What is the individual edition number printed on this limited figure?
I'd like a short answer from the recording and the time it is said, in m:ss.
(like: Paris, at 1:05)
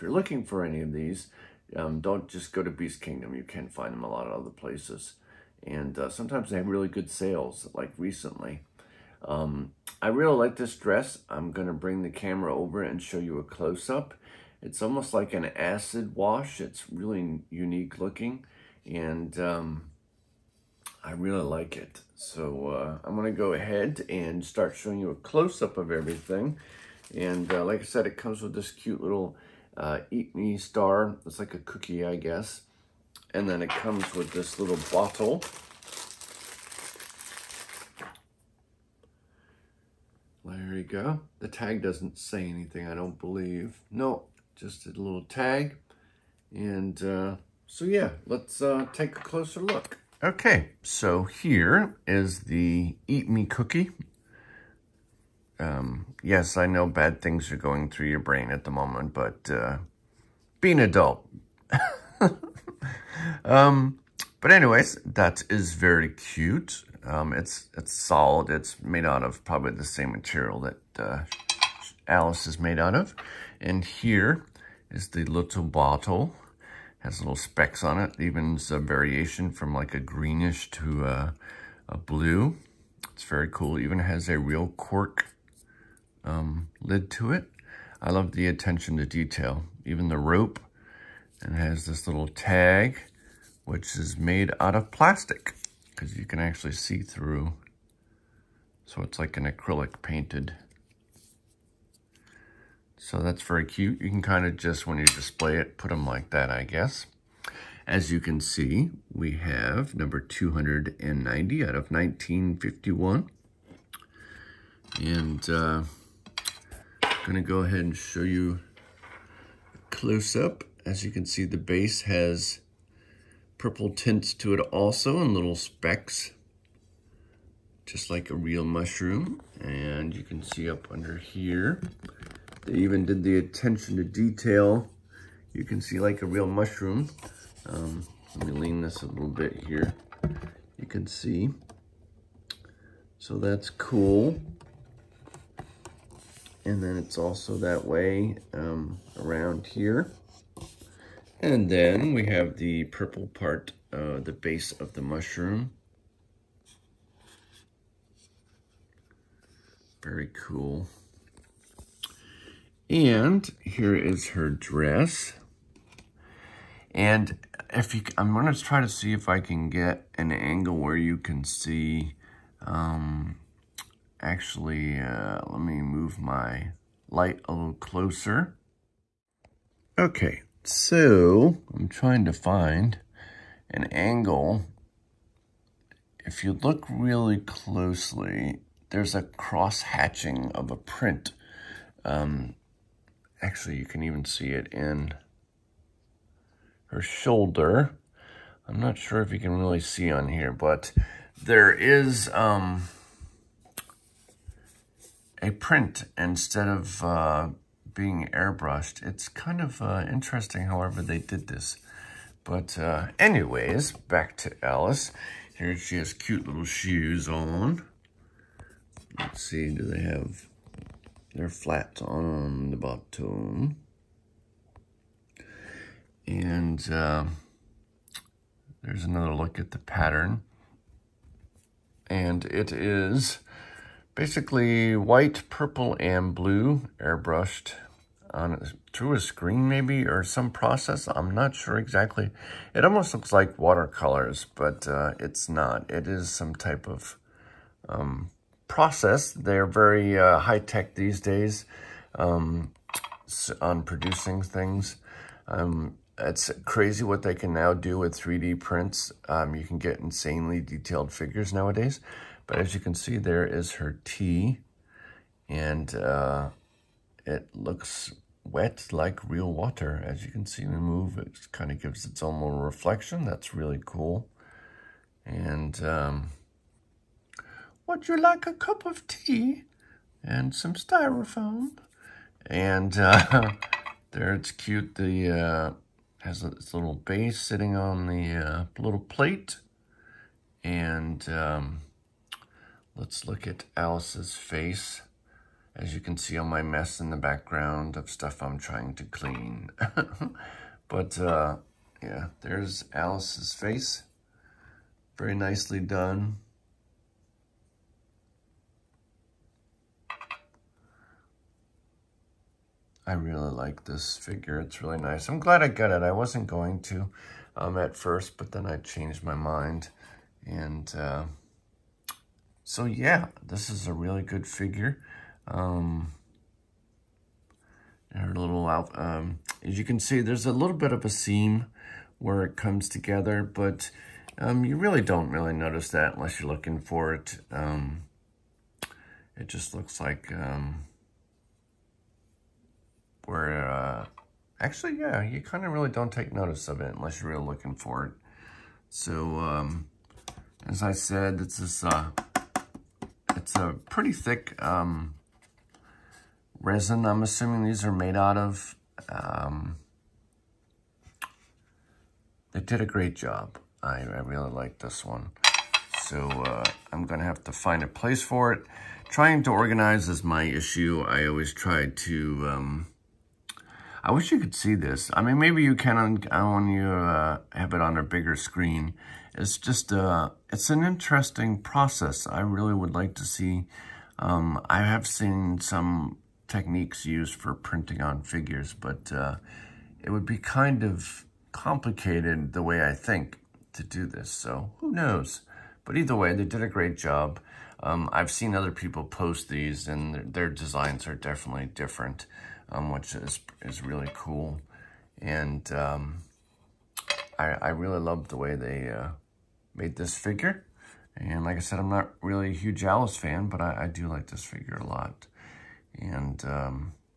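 290, at 1:49.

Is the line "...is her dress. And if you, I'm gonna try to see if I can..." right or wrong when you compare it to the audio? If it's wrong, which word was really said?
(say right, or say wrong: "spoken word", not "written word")
right.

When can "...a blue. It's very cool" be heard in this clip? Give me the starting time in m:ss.
1:21.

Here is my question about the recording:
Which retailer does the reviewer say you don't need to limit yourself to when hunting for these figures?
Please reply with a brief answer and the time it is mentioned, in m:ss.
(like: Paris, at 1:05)
Beast Kingdom, at 0:02.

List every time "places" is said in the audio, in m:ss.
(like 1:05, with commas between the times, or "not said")
0:04, 6:07.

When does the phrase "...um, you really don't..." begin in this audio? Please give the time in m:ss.
5:34.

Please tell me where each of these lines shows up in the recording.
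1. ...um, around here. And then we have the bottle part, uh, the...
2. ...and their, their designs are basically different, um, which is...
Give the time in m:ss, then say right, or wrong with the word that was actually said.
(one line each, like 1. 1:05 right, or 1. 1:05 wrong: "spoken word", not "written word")
1. 2:28 wrong: "purple", not "bottle"
2. 6:39 wrong: "definitely", not "basically".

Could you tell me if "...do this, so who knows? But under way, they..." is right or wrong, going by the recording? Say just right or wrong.
wrong.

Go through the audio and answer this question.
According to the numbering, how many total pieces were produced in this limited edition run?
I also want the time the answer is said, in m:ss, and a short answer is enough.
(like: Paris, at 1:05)
1951, at 1:51.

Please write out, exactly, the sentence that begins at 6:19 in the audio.
It's just, uh, it's an interesting process.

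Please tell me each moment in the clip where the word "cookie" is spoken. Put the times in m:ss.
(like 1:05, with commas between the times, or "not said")
0:31, 0:53.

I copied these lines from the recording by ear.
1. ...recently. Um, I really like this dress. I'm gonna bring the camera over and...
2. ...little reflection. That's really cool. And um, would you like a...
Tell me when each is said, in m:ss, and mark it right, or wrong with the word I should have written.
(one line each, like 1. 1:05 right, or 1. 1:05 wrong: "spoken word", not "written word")
1. 0:07 right
2. 4:32 right.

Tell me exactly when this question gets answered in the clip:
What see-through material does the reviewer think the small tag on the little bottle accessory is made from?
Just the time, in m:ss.
1:39.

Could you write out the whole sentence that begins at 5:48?
So, um, as I said, it's this, uh, it's a pretty thick um, resin.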